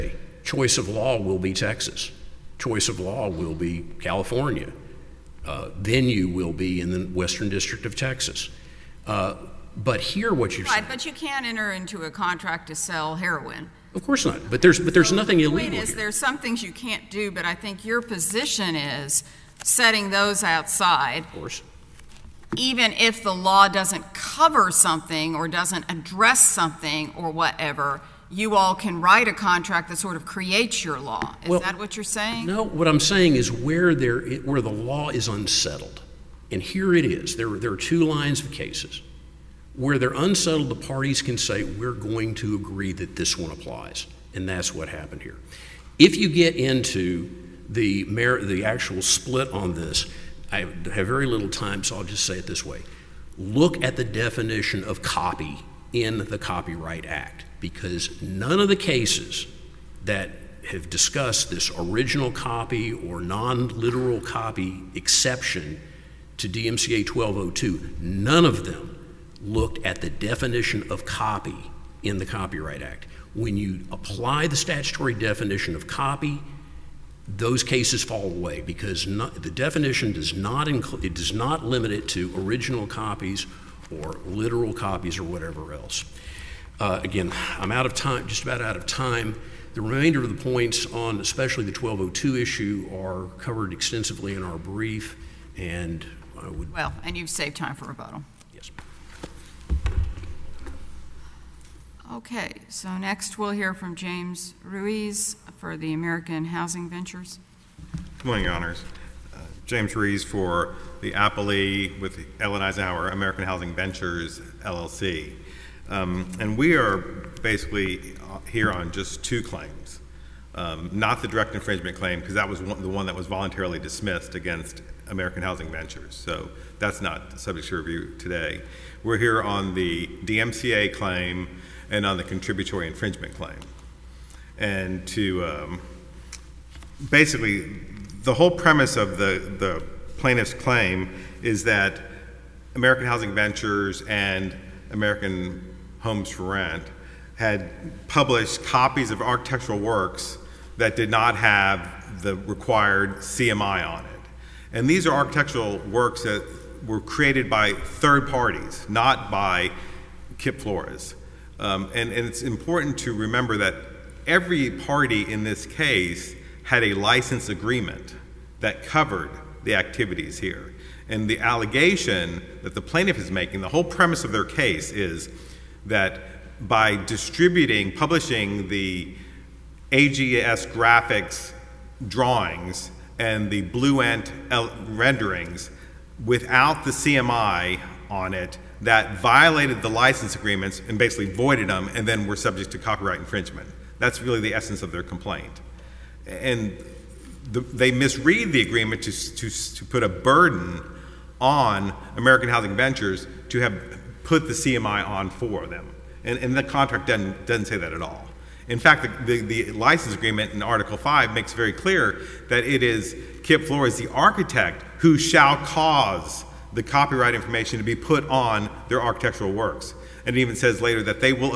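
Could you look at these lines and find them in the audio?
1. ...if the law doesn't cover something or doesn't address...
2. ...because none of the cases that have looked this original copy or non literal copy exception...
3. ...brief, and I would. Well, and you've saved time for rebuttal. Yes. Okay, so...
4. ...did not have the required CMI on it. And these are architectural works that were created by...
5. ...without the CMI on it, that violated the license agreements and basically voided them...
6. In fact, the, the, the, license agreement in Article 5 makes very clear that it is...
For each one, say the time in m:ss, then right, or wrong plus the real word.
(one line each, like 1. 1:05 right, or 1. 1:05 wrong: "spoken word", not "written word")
1. 0:22 right
2. 0:57 wrong: "discussed", not "looked"
3. 1:34 right
4. 2:30 right
5. 3:06 right
6. 3:28 right.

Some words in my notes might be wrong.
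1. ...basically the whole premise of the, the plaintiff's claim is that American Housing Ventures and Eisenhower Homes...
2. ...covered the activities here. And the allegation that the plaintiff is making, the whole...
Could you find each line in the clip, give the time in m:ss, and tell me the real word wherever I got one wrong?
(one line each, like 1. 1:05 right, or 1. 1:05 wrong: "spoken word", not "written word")
1. 2:17 wrong: "American", not "Eisenhower"
2. 2:48 right.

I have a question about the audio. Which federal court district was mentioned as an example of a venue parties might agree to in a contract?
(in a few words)
Western District of Texas.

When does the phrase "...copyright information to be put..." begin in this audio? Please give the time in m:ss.
3:36.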